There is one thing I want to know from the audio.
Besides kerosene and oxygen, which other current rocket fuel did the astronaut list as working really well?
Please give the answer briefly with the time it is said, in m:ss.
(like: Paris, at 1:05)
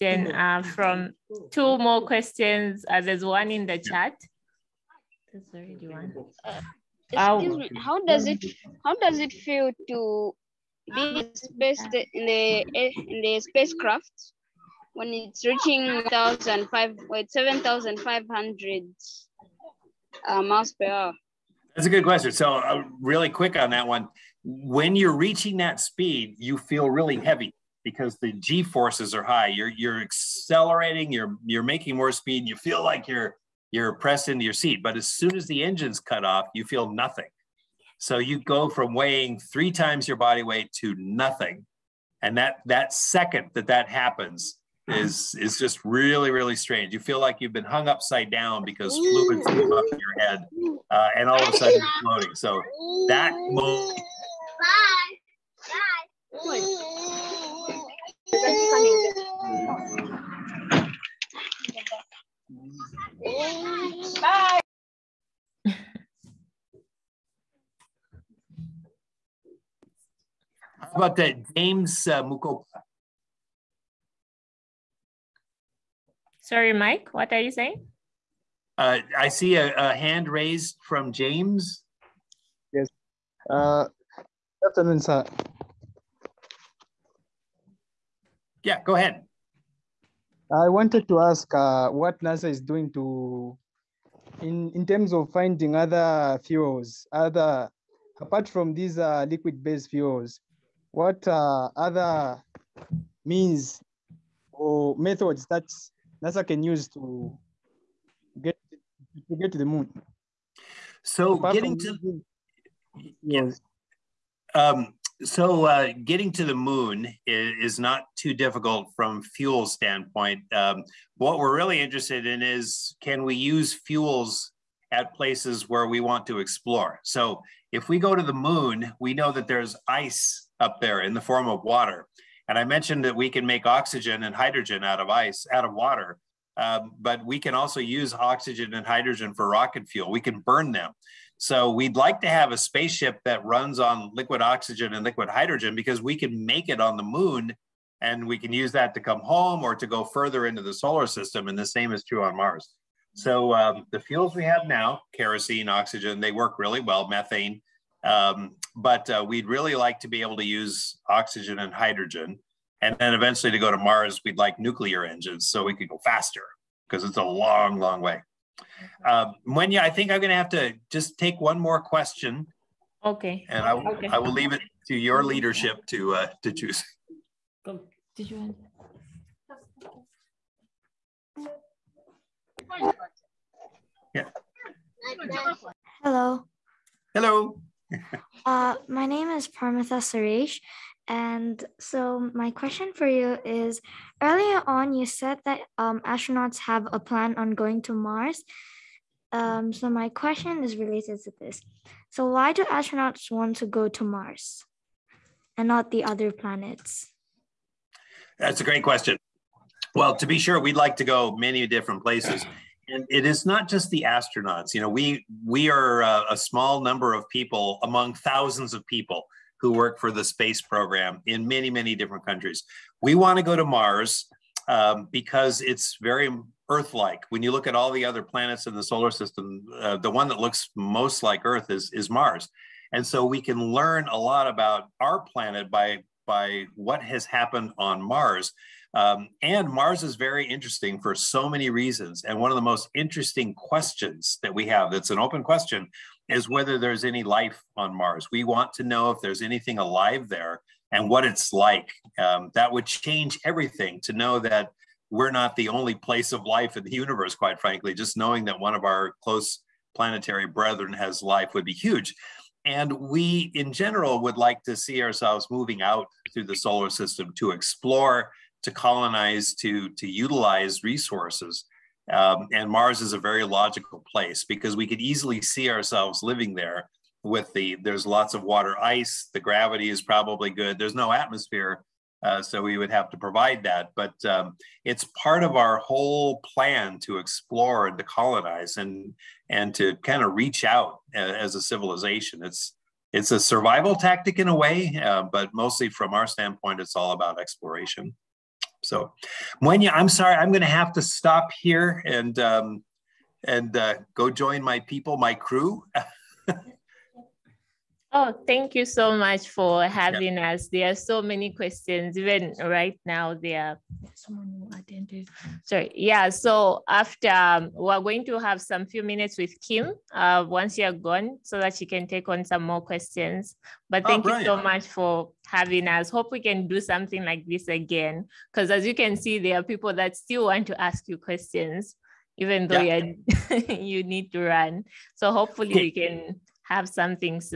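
Methane, at 2:37.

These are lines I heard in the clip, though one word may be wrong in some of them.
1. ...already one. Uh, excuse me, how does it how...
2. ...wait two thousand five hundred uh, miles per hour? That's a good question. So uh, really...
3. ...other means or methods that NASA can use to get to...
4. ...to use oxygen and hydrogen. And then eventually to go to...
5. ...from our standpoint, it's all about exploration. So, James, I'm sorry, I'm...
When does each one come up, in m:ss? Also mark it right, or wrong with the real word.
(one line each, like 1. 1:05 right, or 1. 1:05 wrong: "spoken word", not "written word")
1. 0:05 right
2. 0:17 wrong: "seven", not "two"
3. 1:41 right
4. 2:40 right
5. 4:55 wrong: "Mwenya", not "James".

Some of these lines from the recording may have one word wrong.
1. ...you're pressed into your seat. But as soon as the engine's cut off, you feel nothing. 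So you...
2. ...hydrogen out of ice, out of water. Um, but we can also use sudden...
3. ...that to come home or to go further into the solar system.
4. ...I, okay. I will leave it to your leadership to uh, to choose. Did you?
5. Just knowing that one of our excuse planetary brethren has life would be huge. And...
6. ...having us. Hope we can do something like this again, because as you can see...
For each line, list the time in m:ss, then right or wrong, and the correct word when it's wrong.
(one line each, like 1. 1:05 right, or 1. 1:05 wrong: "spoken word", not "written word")
1. 0:33 right
2. 2:14 wrong: "oxygen", not "sudden"
3. 2:28 right
4. 2:53 right
5. 4:17 wrong: "close", not "excuse"
6. 5:25 right.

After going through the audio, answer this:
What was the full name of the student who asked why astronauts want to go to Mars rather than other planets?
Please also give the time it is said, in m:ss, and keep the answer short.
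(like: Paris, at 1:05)
Parmitha Suresh, at 3:09.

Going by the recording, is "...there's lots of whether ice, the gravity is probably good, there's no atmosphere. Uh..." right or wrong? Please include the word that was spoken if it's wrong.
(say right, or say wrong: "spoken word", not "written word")
wrong: "water", not "whether".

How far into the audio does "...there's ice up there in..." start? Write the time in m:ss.
2:09.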